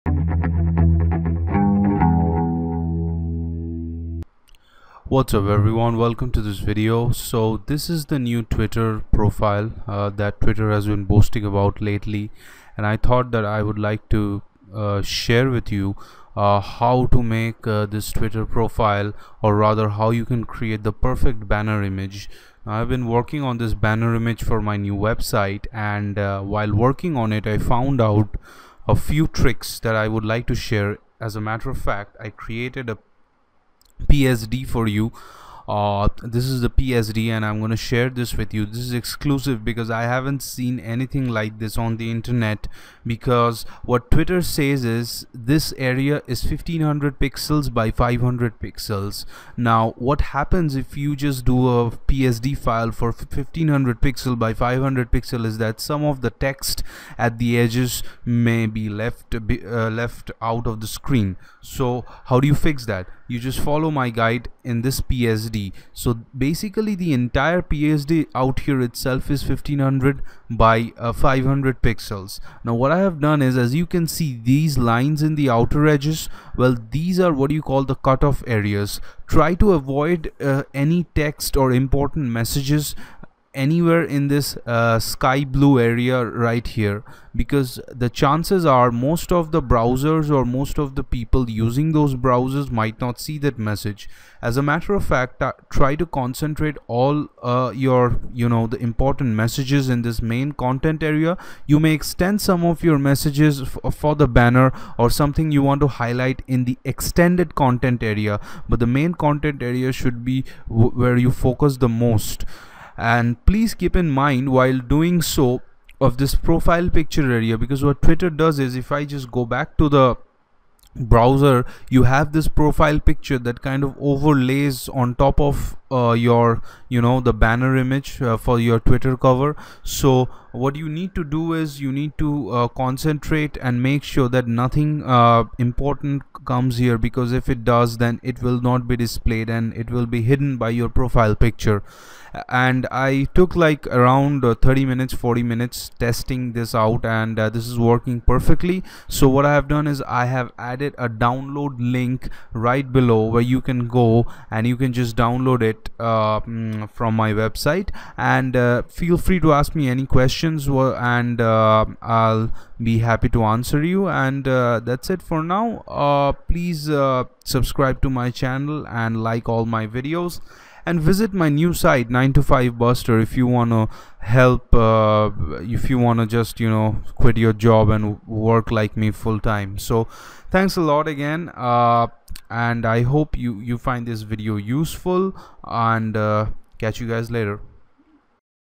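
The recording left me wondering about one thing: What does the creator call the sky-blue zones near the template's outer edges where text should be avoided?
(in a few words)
cutoff areas.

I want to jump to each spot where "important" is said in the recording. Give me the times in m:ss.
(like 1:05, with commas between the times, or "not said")
1:21, 1:38, 2:15.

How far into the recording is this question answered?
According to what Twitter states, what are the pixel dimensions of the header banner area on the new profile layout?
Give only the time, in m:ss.
0:46.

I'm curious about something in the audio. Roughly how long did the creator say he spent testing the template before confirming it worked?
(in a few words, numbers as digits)
30 to 40 minutes.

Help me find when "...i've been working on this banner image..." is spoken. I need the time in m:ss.
0:22.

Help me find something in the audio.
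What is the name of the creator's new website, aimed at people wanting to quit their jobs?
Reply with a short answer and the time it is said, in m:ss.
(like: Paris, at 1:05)
9 to 5 Buster, at 2:52.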